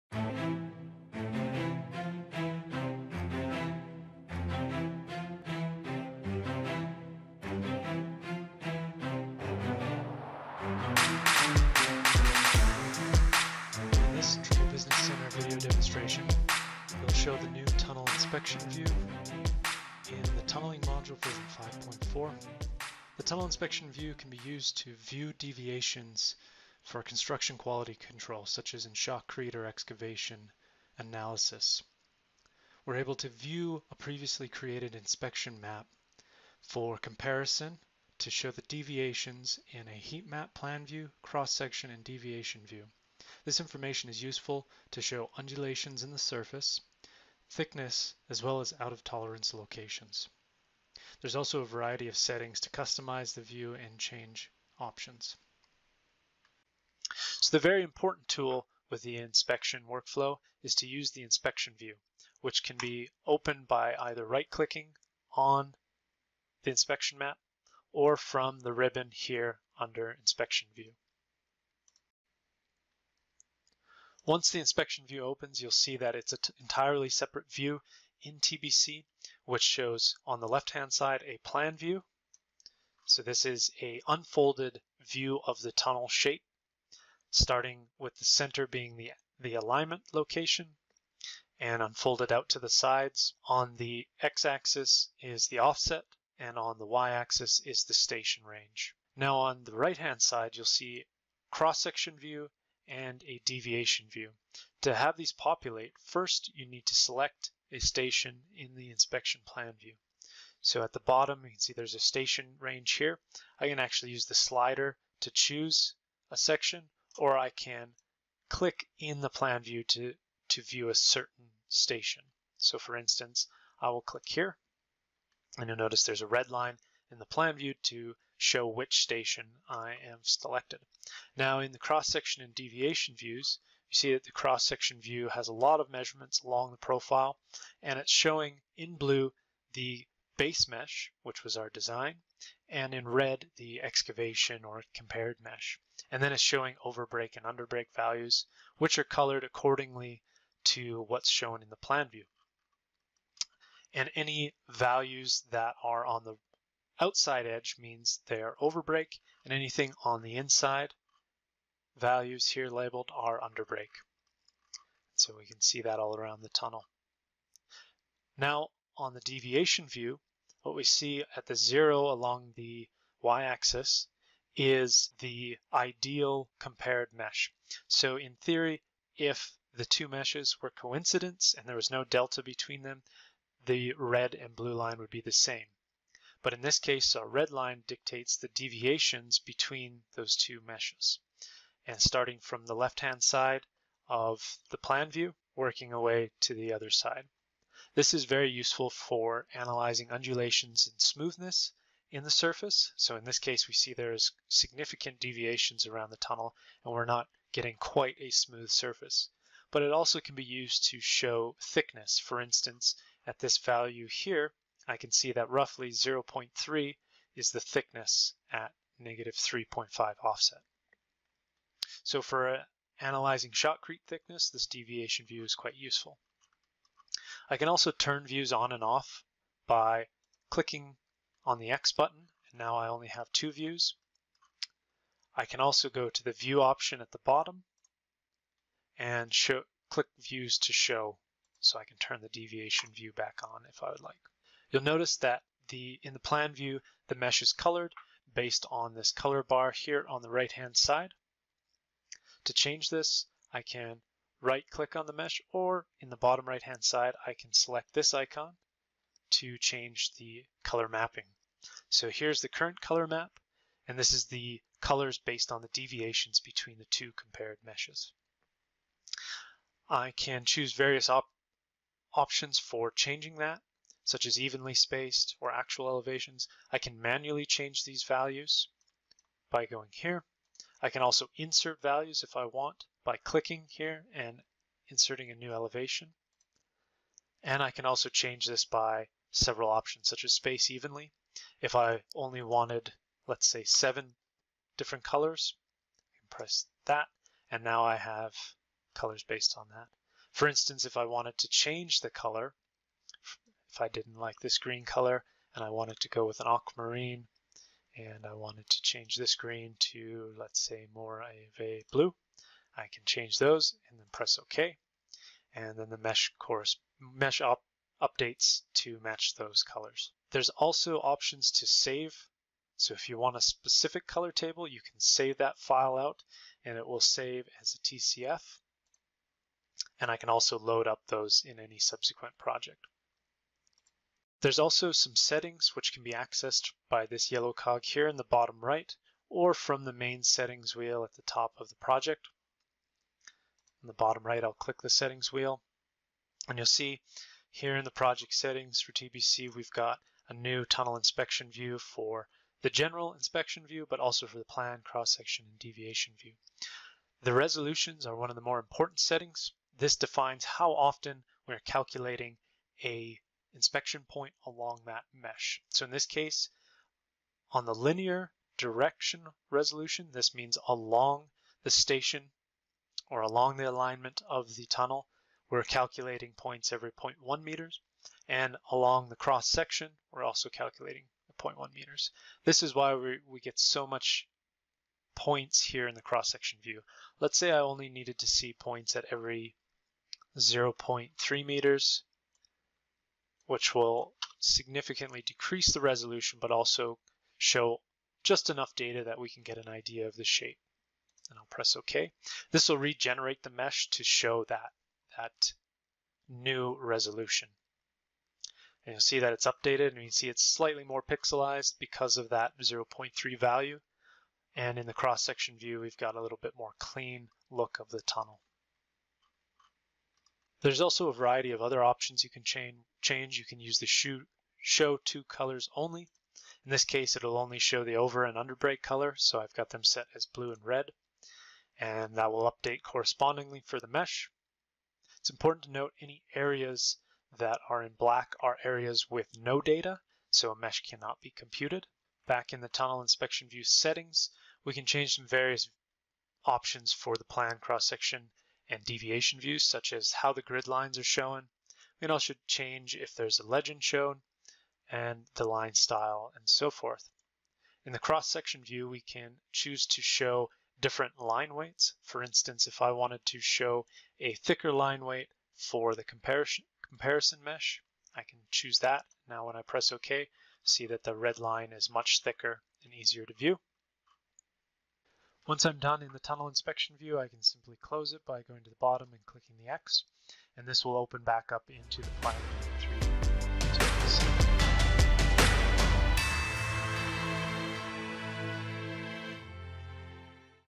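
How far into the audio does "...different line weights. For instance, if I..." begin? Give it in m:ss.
7:40.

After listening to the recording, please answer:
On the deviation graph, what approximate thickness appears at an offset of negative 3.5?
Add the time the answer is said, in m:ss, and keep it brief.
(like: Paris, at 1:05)
0.3, at 3:35.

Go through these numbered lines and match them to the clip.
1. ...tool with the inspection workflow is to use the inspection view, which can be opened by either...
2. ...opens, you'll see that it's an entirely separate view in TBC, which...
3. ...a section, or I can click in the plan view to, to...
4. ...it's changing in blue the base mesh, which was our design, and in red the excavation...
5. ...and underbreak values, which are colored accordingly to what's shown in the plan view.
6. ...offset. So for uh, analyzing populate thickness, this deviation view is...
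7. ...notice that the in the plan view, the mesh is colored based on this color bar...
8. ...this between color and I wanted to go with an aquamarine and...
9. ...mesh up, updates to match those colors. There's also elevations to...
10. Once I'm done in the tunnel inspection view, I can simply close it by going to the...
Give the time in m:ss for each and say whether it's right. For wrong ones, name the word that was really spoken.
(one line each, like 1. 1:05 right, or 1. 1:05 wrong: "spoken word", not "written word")
1. 0:58 right
2. 1:15 right
3. 1:56 right
4. 2:17 wrong: "showing", not "changing"
5. 2:27 right
6. 3:40 wrong: "shotcrete", not "populate"
7. 4:04 right
8. 5:04 wrong: "green", not "between"
9. 5:16 wrong: "options", not "elevations"
10. 7:55 right.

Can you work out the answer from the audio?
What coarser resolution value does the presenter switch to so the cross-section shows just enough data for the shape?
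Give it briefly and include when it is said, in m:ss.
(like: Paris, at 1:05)
0.3 meters, at 6:30.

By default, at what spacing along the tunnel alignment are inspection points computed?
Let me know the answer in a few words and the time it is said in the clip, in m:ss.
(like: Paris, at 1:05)
0.1 meters, at 6:16.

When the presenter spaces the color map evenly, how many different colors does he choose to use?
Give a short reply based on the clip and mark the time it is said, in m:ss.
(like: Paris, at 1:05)
7, at 4:53.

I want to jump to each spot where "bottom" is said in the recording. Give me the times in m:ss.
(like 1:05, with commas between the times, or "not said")
1:50, 3:57, 4:16, 5:38, 5:43, 7:58.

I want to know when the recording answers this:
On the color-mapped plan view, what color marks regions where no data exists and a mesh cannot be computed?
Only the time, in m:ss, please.
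7:17.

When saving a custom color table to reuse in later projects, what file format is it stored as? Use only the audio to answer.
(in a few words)
TCF.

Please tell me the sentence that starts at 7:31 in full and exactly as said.
We can also change if there's a legend shown and the line style and so forth.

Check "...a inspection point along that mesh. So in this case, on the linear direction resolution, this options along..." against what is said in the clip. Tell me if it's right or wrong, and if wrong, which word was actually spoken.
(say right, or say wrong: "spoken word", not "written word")
wrong: "means", not "options".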